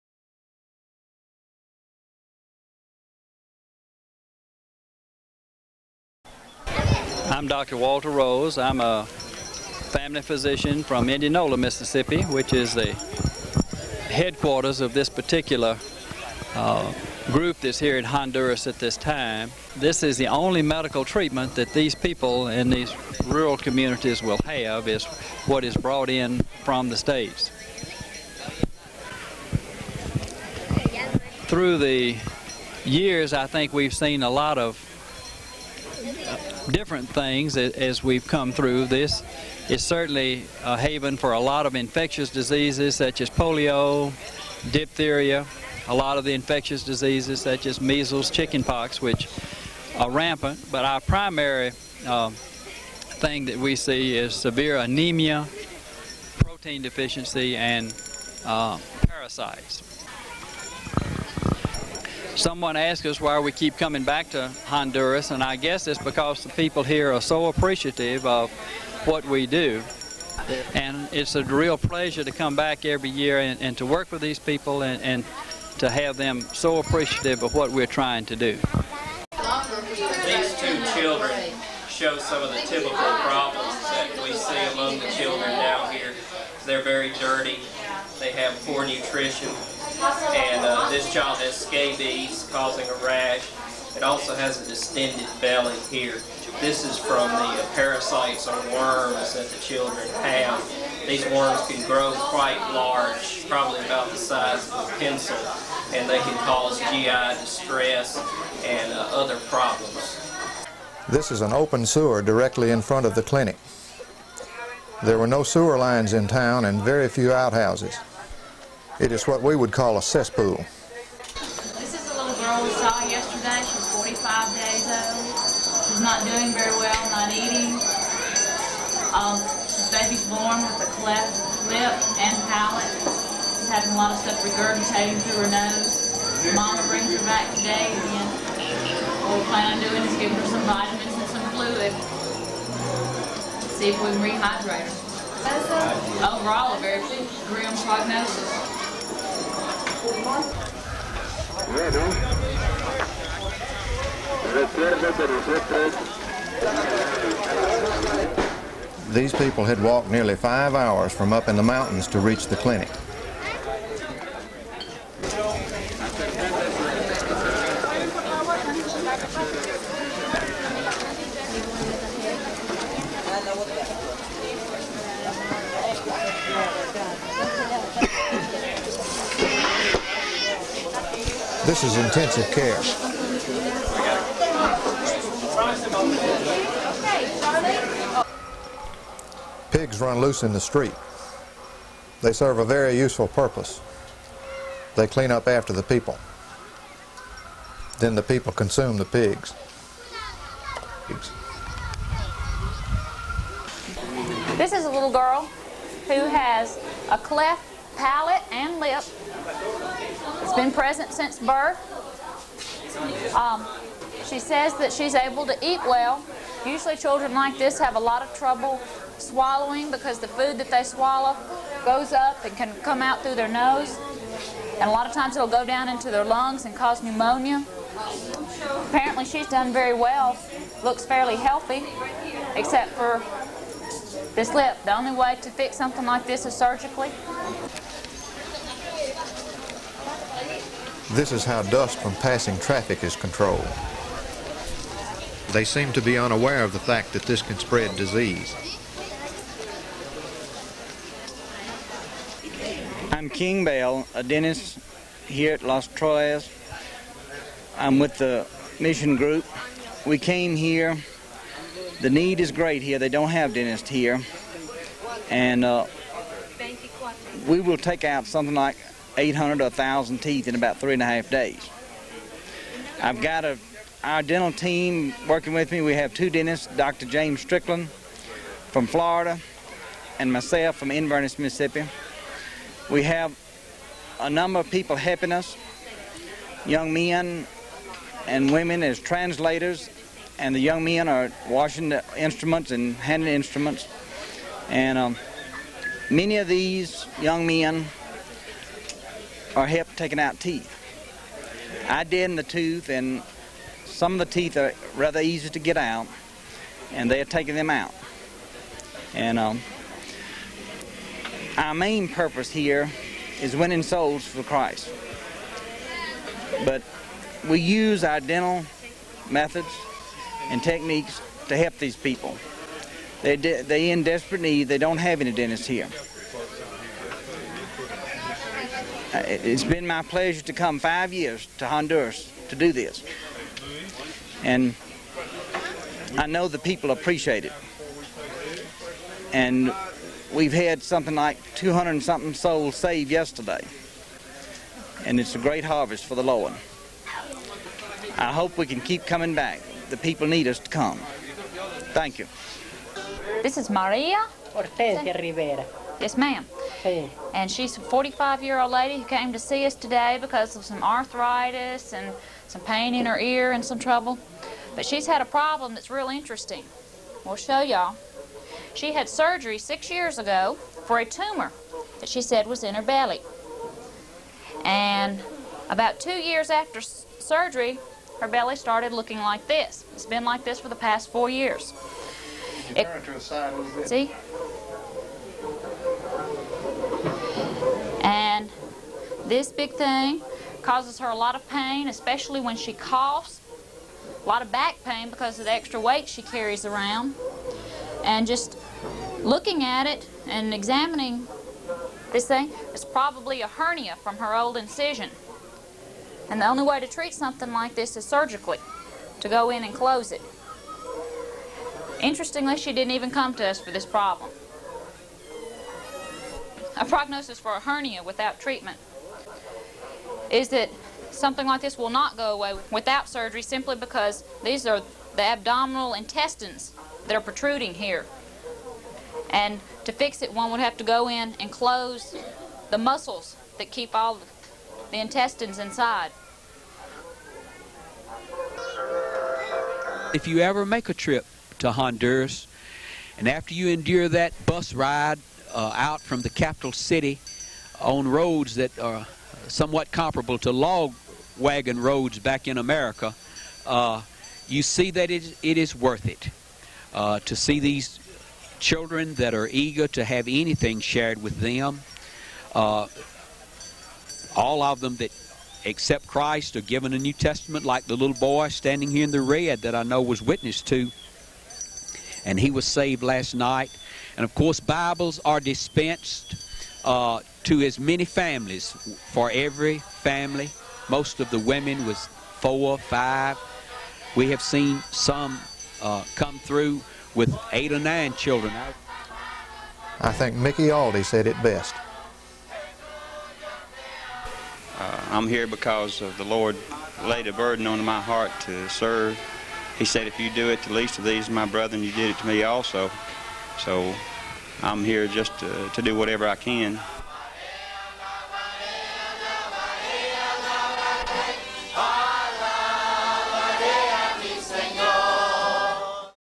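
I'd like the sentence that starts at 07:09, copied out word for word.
And to fix it, one would have to go in and close the muscles that keep all the intestines inside.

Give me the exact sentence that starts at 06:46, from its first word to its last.
And the only way to treat something like this is surgically, to go in and close it.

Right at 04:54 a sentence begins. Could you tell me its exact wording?
And um, many of these young men or help taking out teeth.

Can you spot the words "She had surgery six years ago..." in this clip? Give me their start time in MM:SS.
06:08.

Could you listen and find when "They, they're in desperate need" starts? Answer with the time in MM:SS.
05:23.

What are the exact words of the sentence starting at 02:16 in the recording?
Mama brings her back today again.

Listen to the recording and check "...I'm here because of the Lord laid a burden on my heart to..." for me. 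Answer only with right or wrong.
right.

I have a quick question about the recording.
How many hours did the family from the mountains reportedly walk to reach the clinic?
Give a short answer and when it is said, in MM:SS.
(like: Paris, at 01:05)
5, at 02:40.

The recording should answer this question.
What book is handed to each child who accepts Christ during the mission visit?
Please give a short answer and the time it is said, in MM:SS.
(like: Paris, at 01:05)
New Testament, at 07:46.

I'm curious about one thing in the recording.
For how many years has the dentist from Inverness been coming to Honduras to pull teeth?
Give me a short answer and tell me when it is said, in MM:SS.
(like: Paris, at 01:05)
5, at 05:30.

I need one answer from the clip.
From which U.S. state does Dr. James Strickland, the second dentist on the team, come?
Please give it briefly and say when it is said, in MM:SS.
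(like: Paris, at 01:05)
Florida, at 04:38.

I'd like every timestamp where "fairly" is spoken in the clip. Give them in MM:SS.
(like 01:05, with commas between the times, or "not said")
03:51.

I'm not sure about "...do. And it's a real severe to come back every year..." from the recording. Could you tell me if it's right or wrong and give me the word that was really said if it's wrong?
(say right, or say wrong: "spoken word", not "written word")
wrong: "pleasure", not "severe".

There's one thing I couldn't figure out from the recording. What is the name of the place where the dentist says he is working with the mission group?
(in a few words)
Las Trojes.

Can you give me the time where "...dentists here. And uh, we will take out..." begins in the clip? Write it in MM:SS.
04:23.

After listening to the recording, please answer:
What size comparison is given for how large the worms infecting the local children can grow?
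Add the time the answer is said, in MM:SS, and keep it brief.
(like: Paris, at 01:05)
the size of a pencil, at 01:44.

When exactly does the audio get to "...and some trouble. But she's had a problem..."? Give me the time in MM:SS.
06:03.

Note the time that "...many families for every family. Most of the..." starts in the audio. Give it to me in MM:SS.
07:57.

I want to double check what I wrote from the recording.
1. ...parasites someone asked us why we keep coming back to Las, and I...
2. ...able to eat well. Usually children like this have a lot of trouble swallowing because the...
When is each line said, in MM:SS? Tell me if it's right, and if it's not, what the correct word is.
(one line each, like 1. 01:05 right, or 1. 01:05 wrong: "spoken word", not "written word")
1. 00:59 wrong: "Honduras", not "Las"
2. 03:35 right.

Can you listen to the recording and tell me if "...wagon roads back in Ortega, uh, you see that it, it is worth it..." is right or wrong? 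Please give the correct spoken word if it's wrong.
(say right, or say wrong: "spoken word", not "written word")
wrong: "America", not "Ortega".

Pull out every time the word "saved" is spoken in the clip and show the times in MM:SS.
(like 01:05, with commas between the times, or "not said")
05:42, 07:52.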